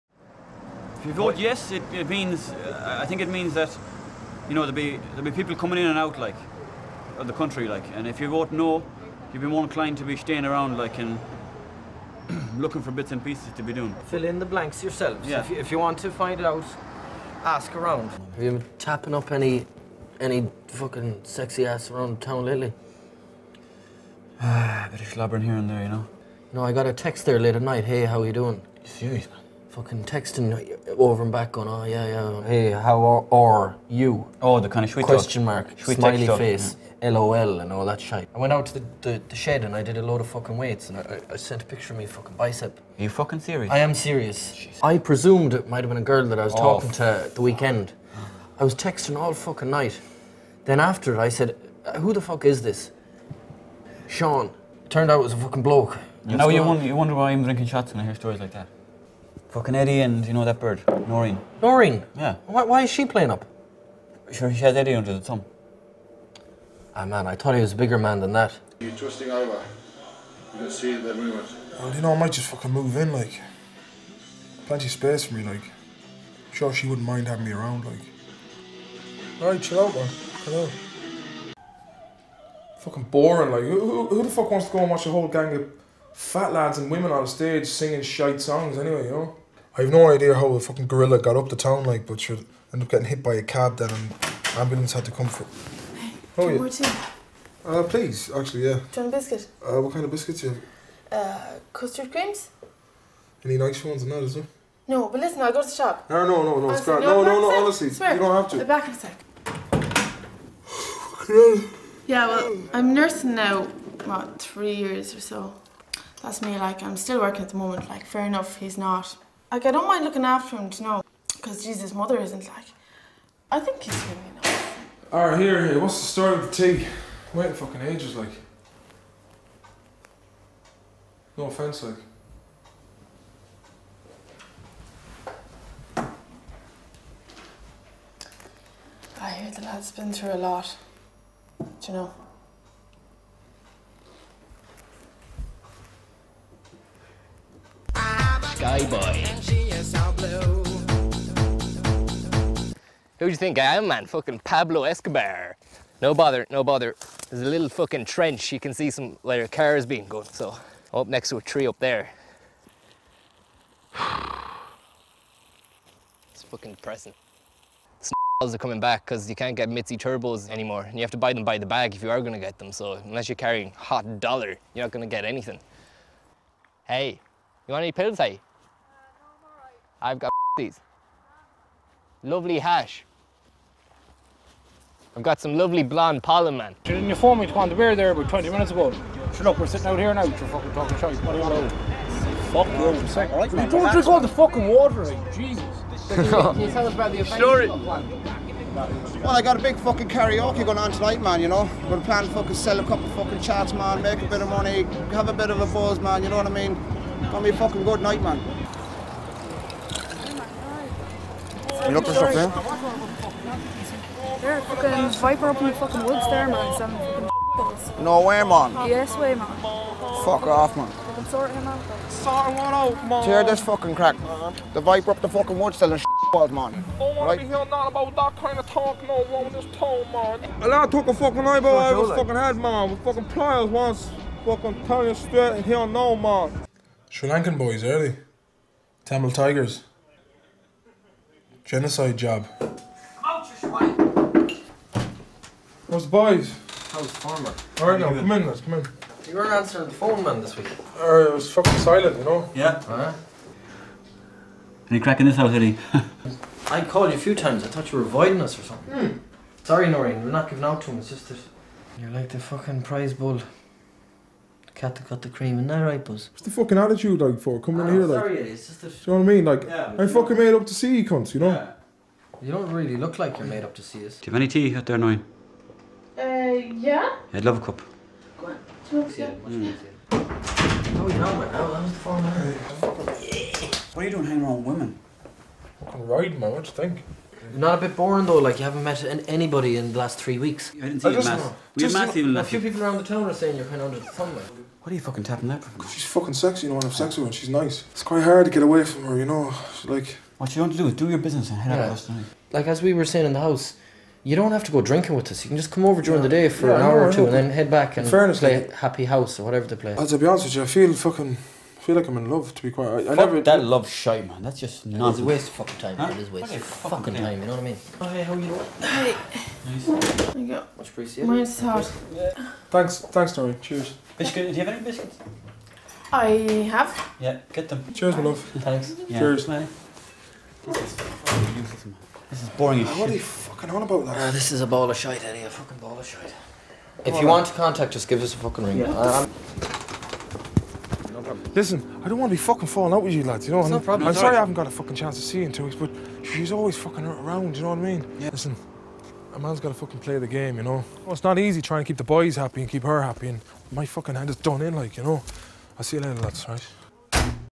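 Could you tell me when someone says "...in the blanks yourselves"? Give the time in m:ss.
0:14.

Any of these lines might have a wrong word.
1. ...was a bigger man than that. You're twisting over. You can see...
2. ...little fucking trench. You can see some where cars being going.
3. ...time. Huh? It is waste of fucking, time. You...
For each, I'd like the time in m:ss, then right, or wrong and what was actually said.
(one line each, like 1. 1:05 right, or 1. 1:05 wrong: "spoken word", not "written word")
1. 1:07 right
2. 2:37 right
3. 5:15 right.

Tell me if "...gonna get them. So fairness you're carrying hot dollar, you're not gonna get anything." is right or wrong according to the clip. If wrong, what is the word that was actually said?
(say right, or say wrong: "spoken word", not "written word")
wrong: "unless", not "fairness".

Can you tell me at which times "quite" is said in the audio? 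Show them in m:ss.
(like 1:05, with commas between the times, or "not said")
4:58, 5:12.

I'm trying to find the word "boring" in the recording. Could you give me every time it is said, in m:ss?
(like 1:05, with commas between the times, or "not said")
1:23, 4:47, 5:32.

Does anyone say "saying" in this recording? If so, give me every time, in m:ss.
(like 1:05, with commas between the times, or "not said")
4:53, 5:03.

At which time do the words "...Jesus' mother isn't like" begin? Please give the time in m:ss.
2:01.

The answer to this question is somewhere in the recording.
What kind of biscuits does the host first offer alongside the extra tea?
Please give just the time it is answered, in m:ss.
1:41.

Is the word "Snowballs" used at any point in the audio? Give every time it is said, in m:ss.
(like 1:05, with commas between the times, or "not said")
2:48.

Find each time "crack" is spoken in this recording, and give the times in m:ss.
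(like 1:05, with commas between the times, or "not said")
3:43, 4:14.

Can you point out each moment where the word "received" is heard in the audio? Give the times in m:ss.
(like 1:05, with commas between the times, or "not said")
not said.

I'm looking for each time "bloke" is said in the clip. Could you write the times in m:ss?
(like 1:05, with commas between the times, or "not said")
0:55.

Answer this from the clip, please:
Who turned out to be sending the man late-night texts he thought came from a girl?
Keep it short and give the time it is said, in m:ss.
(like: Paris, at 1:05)
Sean, at 0:54.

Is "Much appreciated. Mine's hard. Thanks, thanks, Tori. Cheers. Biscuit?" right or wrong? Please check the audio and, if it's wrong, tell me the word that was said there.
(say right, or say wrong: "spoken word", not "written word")
right.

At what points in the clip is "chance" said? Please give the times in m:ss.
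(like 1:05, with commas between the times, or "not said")
5:44.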